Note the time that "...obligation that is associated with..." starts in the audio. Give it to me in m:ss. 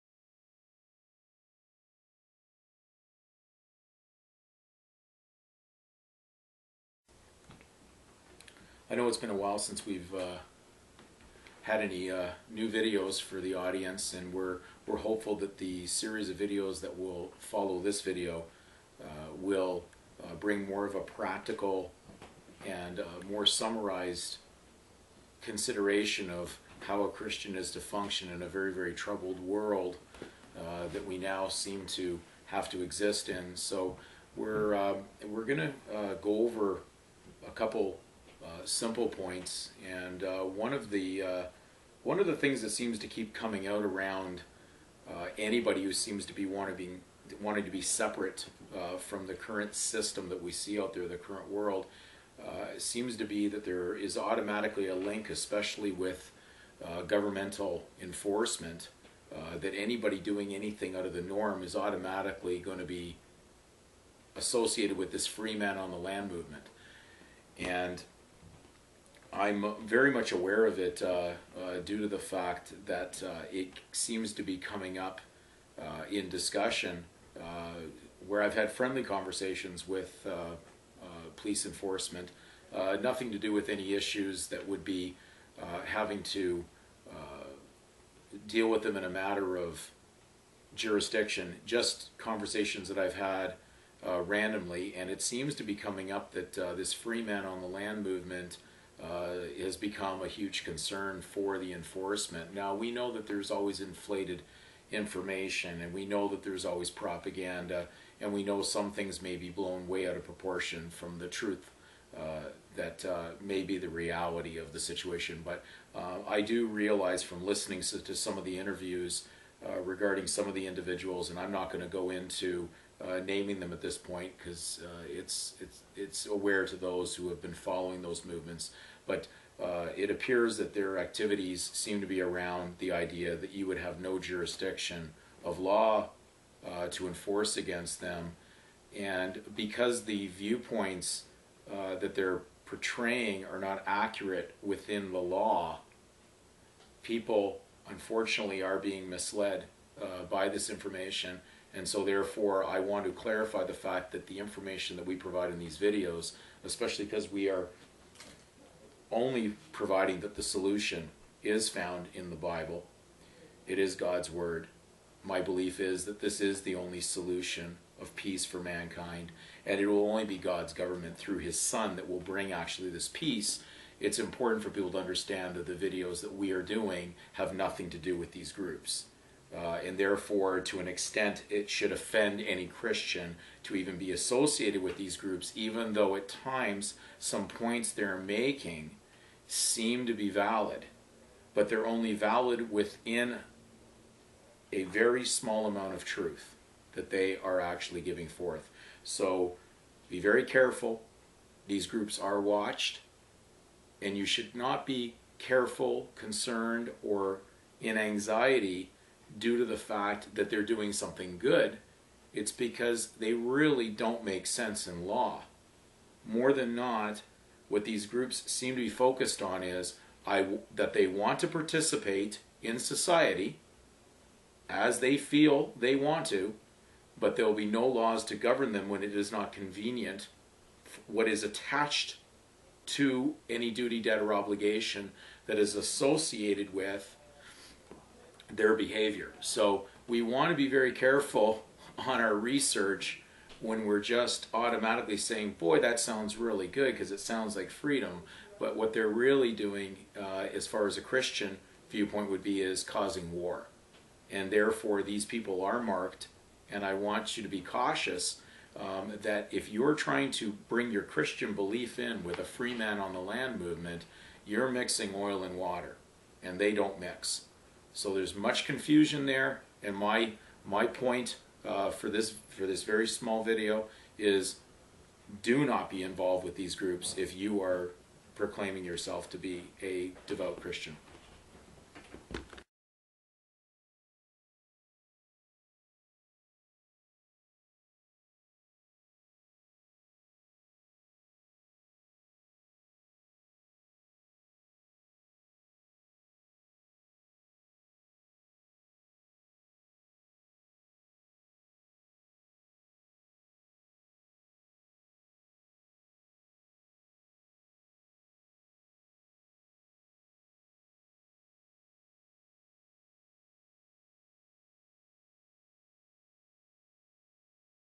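3:54.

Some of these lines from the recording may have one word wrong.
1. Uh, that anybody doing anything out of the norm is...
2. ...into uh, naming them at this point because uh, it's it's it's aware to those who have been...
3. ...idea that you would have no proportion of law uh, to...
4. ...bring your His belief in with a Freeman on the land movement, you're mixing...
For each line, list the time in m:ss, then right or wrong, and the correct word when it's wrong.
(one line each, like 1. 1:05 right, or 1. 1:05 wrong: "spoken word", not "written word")
1. 0:59 right
2. 2:02 right
3. 2:12 wrong: "jurisdiction", not "proportion"
4. 4:20 wrong: "Christian", not "His".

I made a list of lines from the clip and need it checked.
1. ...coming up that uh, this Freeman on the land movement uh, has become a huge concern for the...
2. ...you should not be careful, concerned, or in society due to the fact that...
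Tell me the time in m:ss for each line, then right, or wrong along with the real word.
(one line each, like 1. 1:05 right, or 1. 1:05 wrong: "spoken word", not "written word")
1. 1:35 right
2. 3:24 wrong: "anxiety", not "society".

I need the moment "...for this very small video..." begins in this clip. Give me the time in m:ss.
4:32.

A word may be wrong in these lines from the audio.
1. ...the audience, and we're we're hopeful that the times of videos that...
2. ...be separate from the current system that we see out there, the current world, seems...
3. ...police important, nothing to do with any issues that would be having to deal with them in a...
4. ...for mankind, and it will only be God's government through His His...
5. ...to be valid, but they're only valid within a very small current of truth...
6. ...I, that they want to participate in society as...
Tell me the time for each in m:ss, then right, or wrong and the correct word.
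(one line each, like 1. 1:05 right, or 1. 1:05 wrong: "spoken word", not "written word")
1. 0:13 wrong: "series", not "times"
2. 0:47 right
3. 1:21 wrong: "enforcement", not "important"
4. 2:48 wrong: "Son", not "His"
5. 3:10 wrong: "amount", not "current"
6. 3:40 right.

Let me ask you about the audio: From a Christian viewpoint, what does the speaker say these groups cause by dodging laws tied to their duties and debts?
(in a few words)
War.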